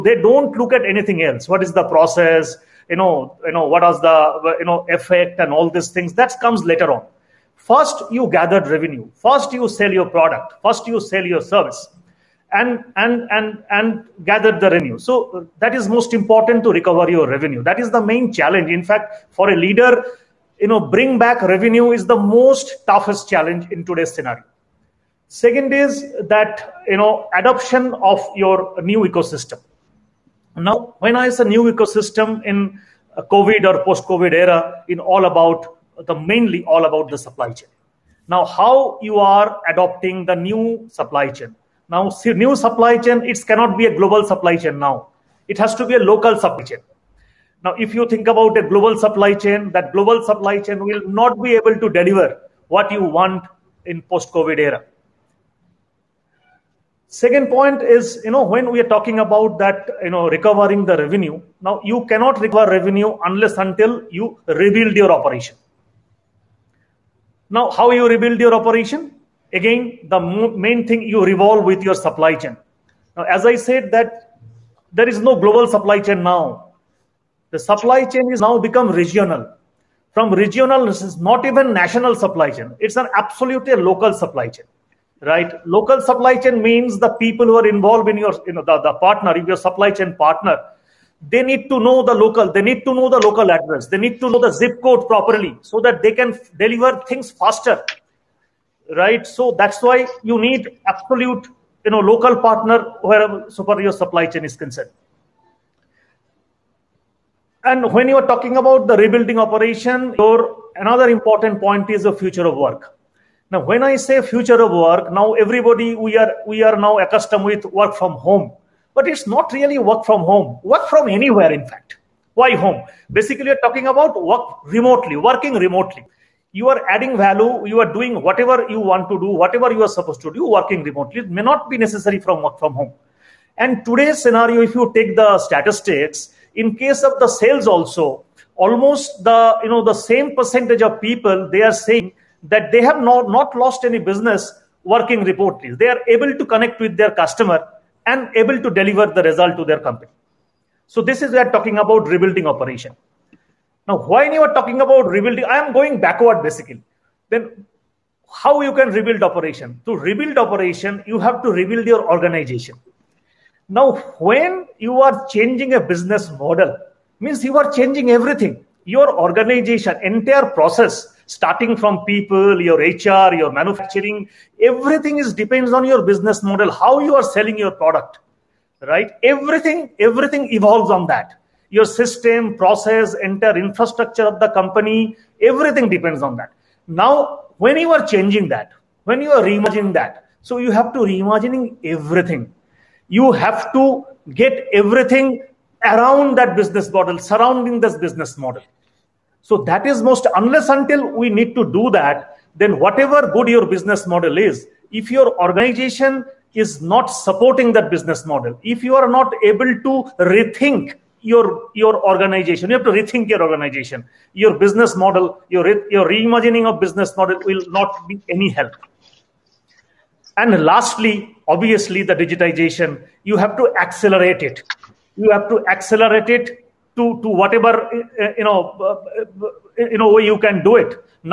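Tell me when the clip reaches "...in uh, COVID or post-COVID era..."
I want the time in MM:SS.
00:32.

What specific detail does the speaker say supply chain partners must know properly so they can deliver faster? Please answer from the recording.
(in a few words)
Zip code.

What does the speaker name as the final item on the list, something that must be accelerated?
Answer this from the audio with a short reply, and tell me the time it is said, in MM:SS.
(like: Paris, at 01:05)
Digitization, at 03:42.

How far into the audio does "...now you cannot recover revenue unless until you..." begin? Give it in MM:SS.
01:01.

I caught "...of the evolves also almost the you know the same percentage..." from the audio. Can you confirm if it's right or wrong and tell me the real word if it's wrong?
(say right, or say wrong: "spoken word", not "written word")
wrong: "sales", not "evolves".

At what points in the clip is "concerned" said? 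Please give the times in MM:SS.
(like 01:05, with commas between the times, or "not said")
01:44.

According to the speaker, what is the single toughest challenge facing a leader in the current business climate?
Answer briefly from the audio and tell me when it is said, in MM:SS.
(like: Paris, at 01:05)
Bring back revenue, at 00:20.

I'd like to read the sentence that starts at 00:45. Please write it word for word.
It has to be a local supply chain.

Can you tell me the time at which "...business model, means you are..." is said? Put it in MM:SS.
02:45.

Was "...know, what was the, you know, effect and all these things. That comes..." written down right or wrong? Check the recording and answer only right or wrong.
right.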